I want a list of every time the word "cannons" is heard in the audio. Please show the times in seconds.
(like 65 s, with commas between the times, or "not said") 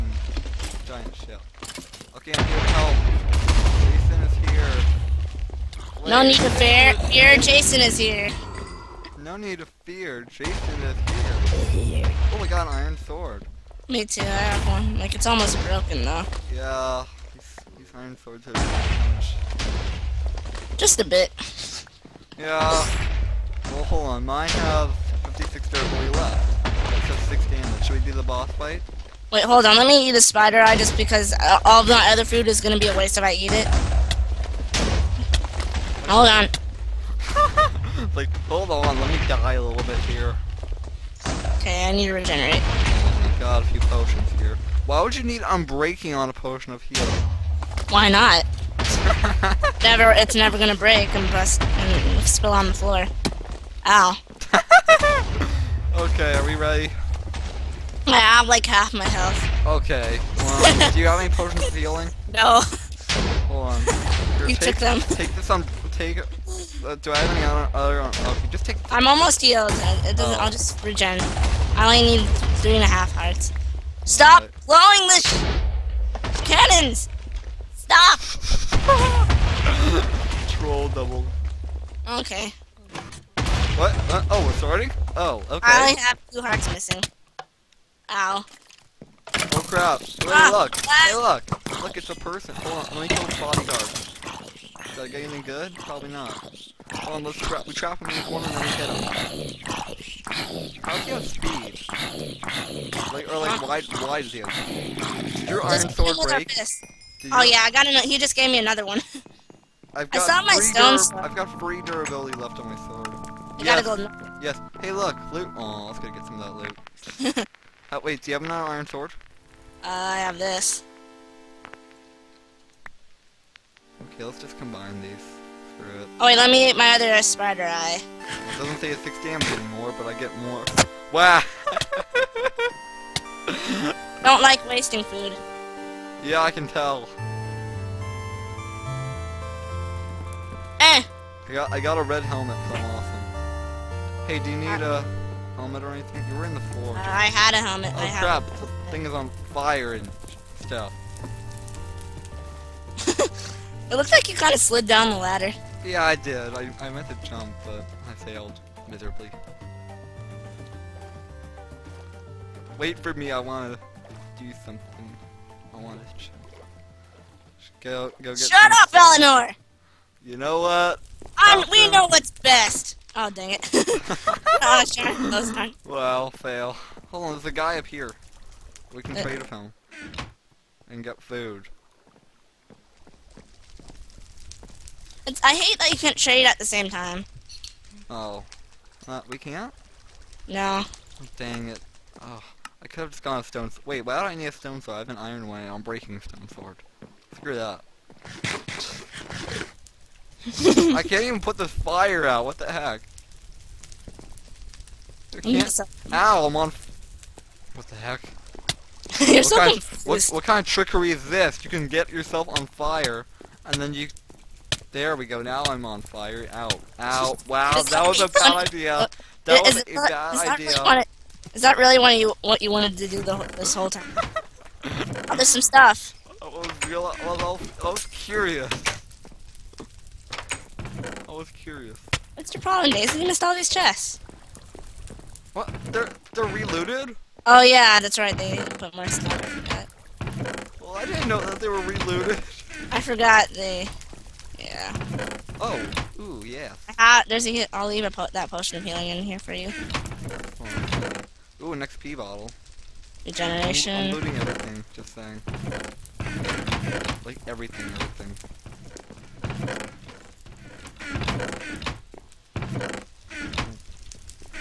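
76 s.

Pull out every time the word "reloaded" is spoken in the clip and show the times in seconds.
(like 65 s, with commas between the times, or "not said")
236 s, 241 s.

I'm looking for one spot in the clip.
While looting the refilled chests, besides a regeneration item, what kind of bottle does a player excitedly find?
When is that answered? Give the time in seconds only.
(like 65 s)
251 s.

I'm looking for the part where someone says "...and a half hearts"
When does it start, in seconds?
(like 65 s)
72 s.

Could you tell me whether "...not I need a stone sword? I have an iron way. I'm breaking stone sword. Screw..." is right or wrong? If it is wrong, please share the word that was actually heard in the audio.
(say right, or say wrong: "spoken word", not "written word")
right.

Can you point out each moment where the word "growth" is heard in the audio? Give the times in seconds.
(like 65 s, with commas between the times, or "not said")
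not said.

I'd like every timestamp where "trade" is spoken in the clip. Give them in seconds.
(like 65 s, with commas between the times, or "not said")
179 s, 186 s.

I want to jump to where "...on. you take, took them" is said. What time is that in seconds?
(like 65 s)
63 s.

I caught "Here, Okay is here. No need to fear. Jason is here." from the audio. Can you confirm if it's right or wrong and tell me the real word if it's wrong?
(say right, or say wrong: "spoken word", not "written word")
wrong: "Jason", not "Okay".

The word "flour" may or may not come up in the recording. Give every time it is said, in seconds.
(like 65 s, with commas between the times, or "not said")
not said.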